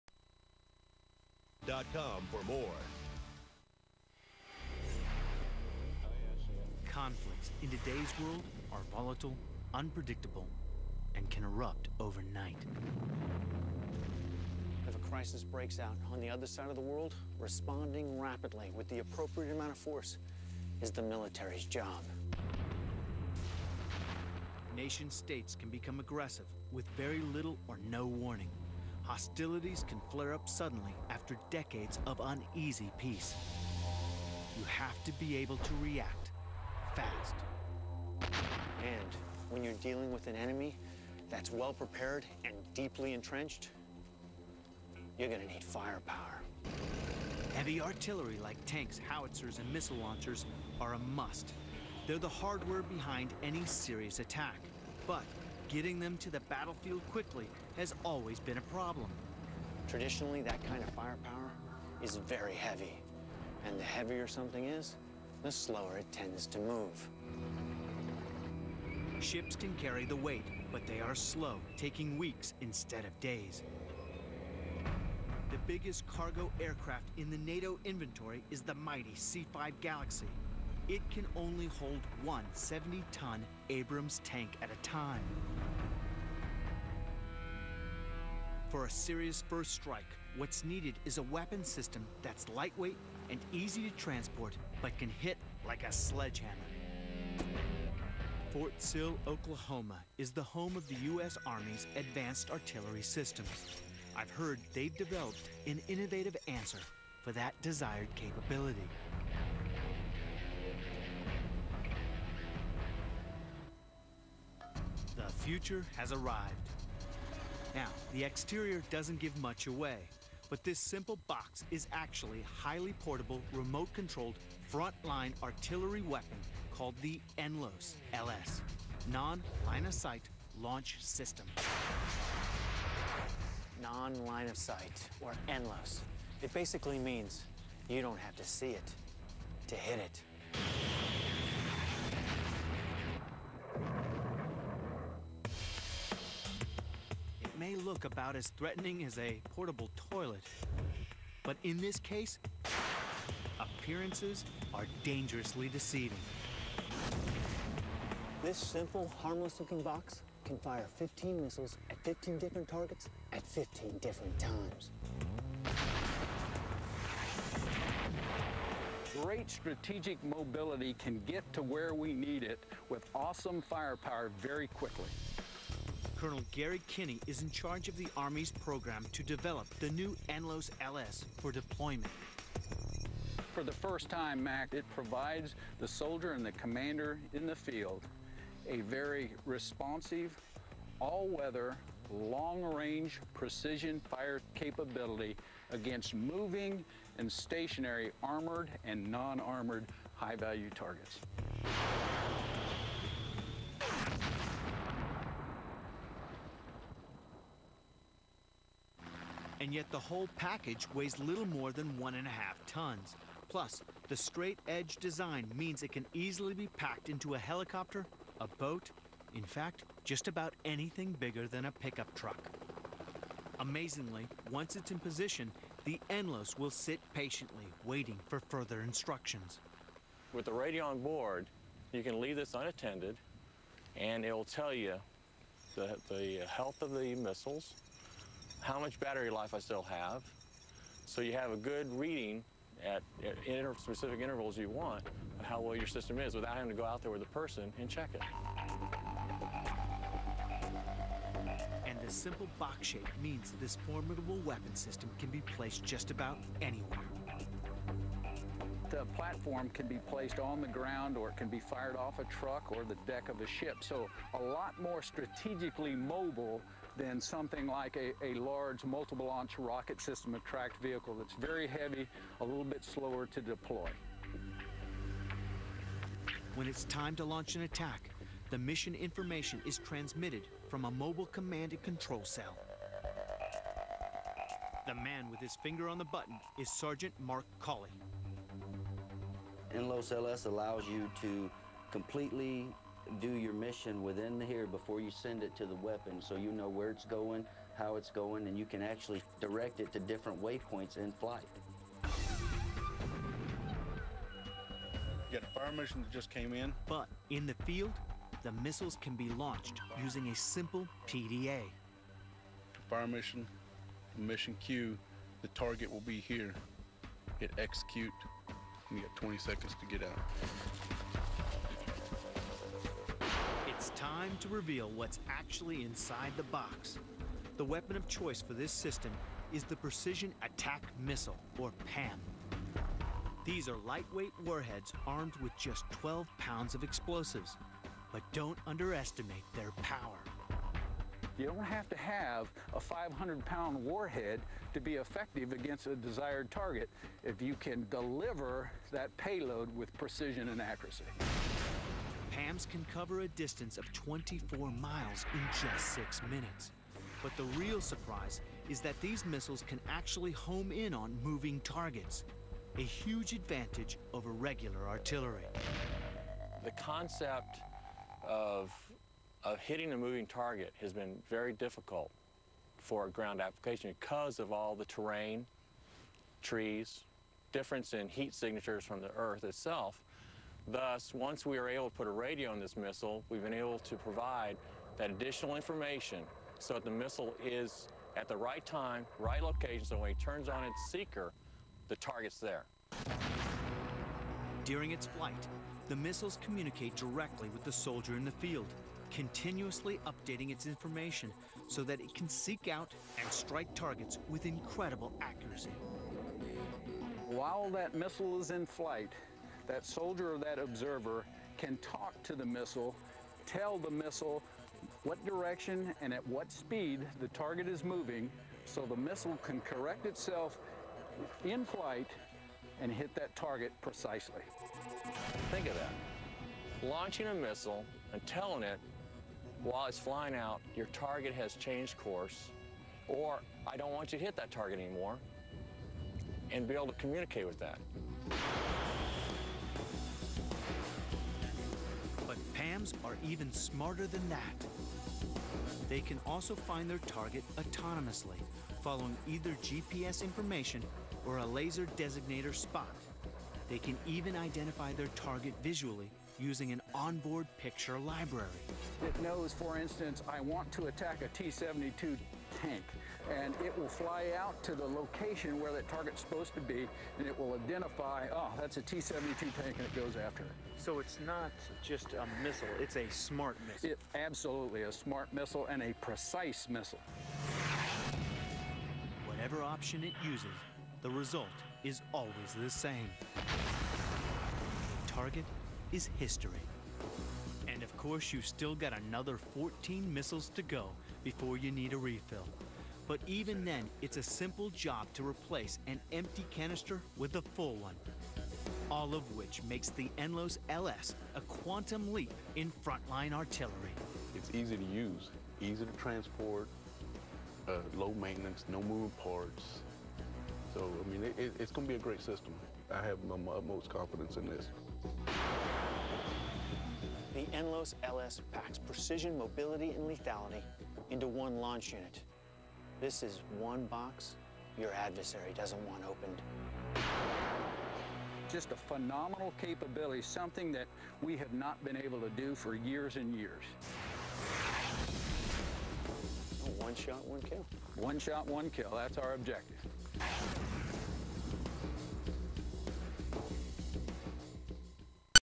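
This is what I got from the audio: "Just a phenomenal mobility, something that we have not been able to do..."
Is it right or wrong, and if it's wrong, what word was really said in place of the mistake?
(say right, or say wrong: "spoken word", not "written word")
wrong: "capability", not "mobility".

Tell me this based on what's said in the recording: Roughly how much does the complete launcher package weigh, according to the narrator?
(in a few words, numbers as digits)
one and a half tons.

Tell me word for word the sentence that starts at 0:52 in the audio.
They're the hardware behind any serious attack.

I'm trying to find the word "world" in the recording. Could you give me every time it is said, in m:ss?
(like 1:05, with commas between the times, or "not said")
0:08, 0:16.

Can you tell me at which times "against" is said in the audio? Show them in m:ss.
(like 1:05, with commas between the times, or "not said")
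3:15, 5:45.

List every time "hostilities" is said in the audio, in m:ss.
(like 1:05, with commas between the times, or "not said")
0:29.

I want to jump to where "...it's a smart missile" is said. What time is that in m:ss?
7:52.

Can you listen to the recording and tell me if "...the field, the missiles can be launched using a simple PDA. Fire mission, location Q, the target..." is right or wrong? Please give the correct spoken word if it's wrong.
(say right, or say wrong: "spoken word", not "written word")
wrong: "mission", not "location".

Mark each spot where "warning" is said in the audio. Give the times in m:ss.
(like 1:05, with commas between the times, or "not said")
0:28.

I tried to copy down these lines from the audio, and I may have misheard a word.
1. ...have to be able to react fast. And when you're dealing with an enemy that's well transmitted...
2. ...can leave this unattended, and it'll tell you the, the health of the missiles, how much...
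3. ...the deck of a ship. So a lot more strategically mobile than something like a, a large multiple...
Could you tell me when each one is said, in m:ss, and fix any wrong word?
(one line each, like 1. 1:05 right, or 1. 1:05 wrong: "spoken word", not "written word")
1. 0:34 wrong: "prepared", not "transmitted"
2. 3:52 right
3. 4:22 right.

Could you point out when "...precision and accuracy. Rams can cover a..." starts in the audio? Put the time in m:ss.
5:49.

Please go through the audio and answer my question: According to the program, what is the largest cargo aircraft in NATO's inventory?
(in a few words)
C-5 Galaxy.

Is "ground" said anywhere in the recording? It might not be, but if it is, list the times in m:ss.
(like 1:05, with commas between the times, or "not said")
4:20, 6:13.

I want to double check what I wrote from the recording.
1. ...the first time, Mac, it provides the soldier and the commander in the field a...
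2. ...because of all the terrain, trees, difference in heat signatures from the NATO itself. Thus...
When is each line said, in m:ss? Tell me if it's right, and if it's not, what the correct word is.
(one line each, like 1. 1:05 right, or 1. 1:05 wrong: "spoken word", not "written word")
1. 3:03 right
2. 6:13 wrong: "Earth", not "NATO".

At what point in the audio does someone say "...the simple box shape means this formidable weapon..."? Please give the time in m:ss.
4:12.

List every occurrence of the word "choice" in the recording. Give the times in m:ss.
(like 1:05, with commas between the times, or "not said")
5:28.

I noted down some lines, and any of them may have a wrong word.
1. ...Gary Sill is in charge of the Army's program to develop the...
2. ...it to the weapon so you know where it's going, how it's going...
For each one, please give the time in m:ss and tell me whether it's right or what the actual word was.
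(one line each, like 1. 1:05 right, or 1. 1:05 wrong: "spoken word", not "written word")
1. 2:56 wrong: "Kinney", not "Sill"
2. 4:55 right.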